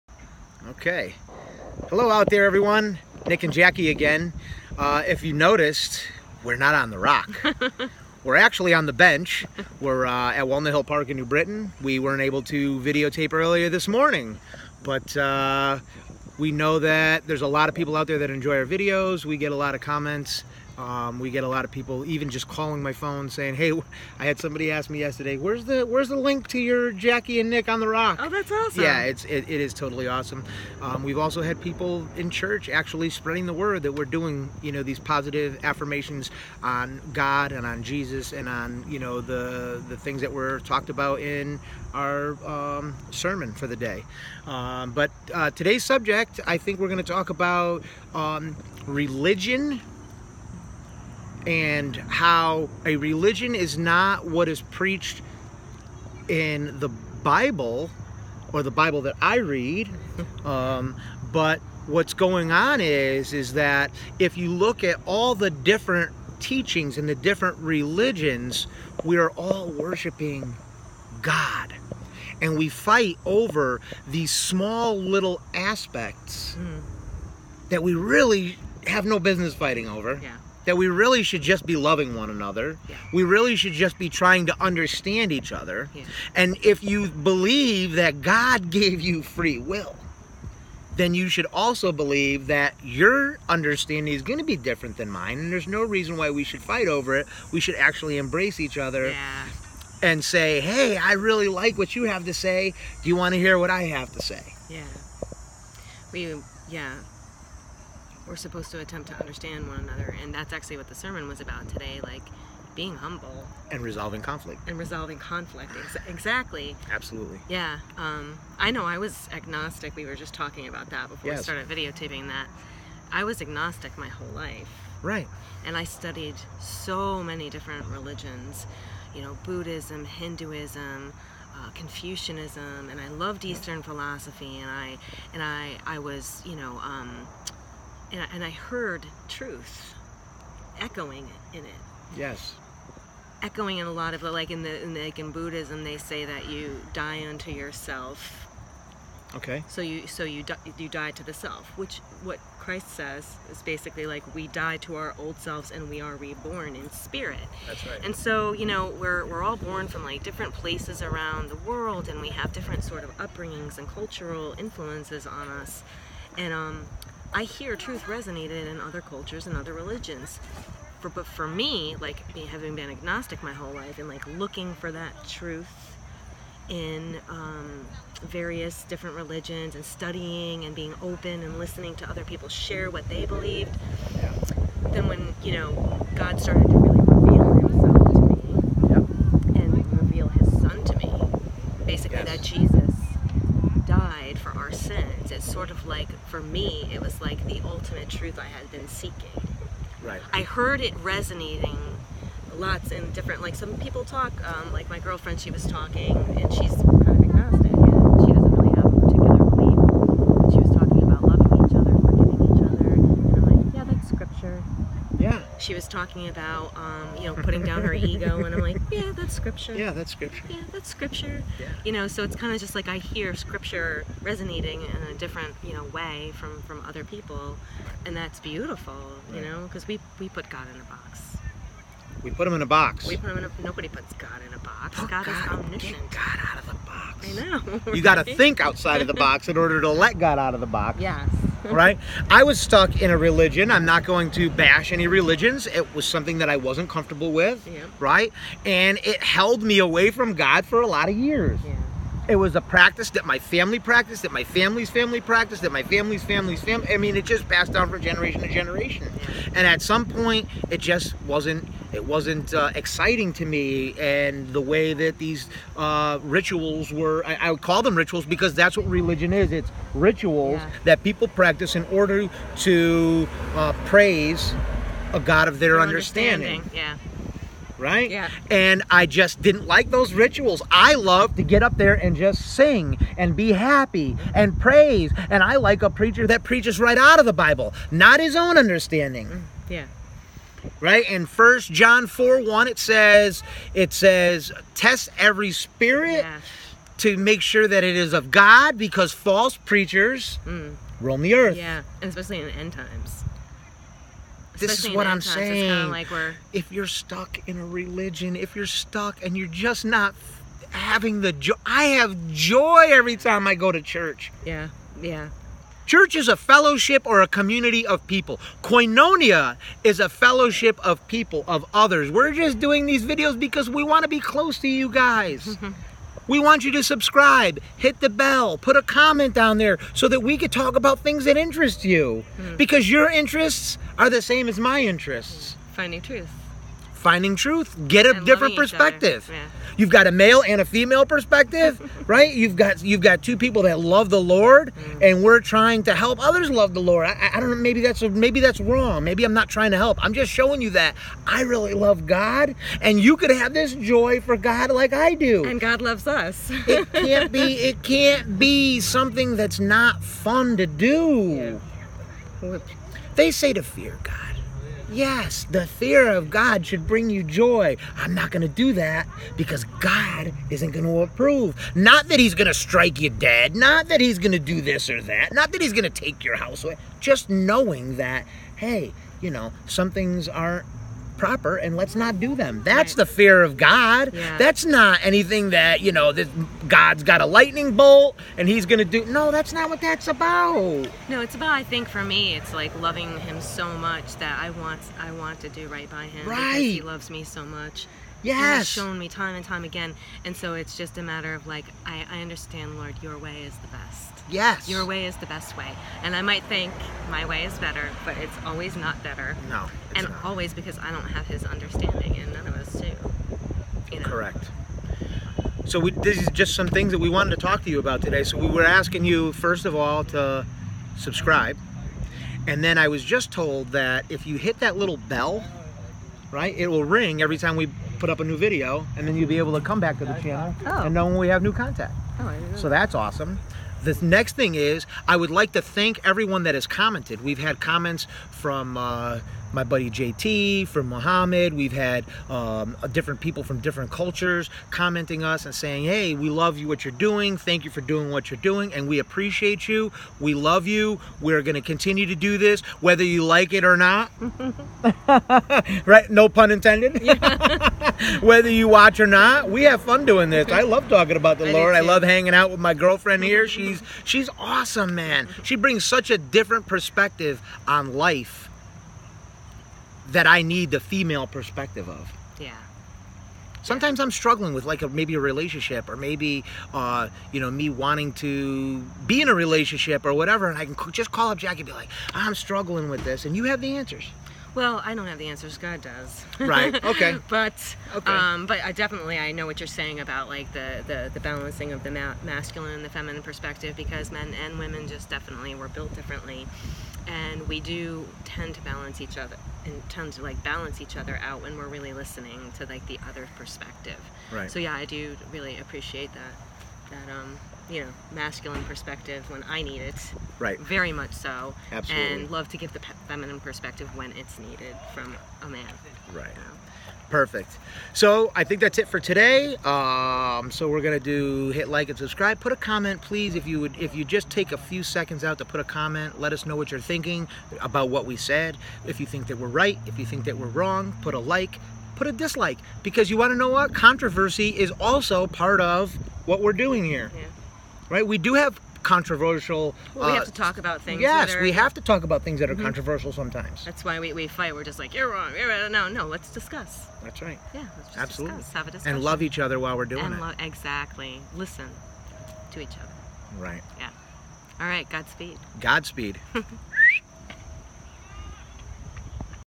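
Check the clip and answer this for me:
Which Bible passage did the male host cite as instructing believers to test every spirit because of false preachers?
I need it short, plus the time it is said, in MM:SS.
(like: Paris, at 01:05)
First John 4:1, at 04:51.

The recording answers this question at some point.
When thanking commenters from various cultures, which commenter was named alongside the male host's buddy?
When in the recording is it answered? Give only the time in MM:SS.
07:20.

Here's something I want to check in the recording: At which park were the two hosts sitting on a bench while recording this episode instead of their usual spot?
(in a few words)
Walnut Hill Park.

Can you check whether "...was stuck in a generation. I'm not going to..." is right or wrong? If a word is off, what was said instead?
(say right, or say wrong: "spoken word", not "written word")
wrong: "religion", not "generation".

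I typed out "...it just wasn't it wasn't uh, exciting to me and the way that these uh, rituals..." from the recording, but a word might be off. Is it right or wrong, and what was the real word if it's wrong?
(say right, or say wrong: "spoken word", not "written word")
right.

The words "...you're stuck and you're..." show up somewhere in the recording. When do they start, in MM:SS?
05:08.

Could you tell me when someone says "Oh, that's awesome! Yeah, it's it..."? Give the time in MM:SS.
00:28.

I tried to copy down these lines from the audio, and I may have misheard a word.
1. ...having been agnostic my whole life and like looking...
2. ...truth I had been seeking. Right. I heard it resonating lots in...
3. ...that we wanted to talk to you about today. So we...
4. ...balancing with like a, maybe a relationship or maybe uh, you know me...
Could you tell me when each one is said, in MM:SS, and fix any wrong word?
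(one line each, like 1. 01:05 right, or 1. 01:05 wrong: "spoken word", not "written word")
1. 02:52 right
2. 03:18 right
3. 06:56 right
4. 07:54 wrong: "struggling", not "balancing".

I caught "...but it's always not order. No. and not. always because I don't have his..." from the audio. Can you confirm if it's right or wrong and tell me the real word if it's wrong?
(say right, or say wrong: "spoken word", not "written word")
wrong: "better", not "order".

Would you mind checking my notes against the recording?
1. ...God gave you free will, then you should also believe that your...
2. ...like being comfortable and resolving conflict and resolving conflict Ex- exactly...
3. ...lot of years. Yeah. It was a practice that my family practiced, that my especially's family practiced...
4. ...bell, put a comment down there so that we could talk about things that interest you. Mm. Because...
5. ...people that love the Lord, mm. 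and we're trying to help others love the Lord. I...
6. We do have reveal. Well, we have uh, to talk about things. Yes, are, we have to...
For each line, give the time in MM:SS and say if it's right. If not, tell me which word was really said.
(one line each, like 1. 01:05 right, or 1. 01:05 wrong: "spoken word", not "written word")
1. 01:28 right
2. 01:52 wrong: "humble", not "comfortable"
3. 04:10 wrong: "family", not "especially"
4. 05:28 right
5. 05:43 right
6. 08:58 wrong: "controversial", not "reveal".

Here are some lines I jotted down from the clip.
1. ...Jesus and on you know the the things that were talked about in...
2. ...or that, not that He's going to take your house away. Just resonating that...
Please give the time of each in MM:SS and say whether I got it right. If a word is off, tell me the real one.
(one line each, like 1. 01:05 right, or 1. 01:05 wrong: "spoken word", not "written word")
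1. 00:37 right
2. 06:14 wrong: "knowing", not "resonating".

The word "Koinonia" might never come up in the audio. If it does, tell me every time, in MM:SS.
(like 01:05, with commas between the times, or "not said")
05:18.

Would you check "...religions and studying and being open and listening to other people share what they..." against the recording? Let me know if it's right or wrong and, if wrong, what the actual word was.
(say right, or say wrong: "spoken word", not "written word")
right.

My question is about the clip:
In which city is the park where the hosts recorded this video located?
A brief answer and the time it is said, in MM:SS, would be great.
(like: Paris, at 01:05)
New Britain, at 00:11.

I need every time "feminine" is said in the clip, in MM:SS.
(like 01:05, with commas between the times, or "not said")
08:12, 08:33.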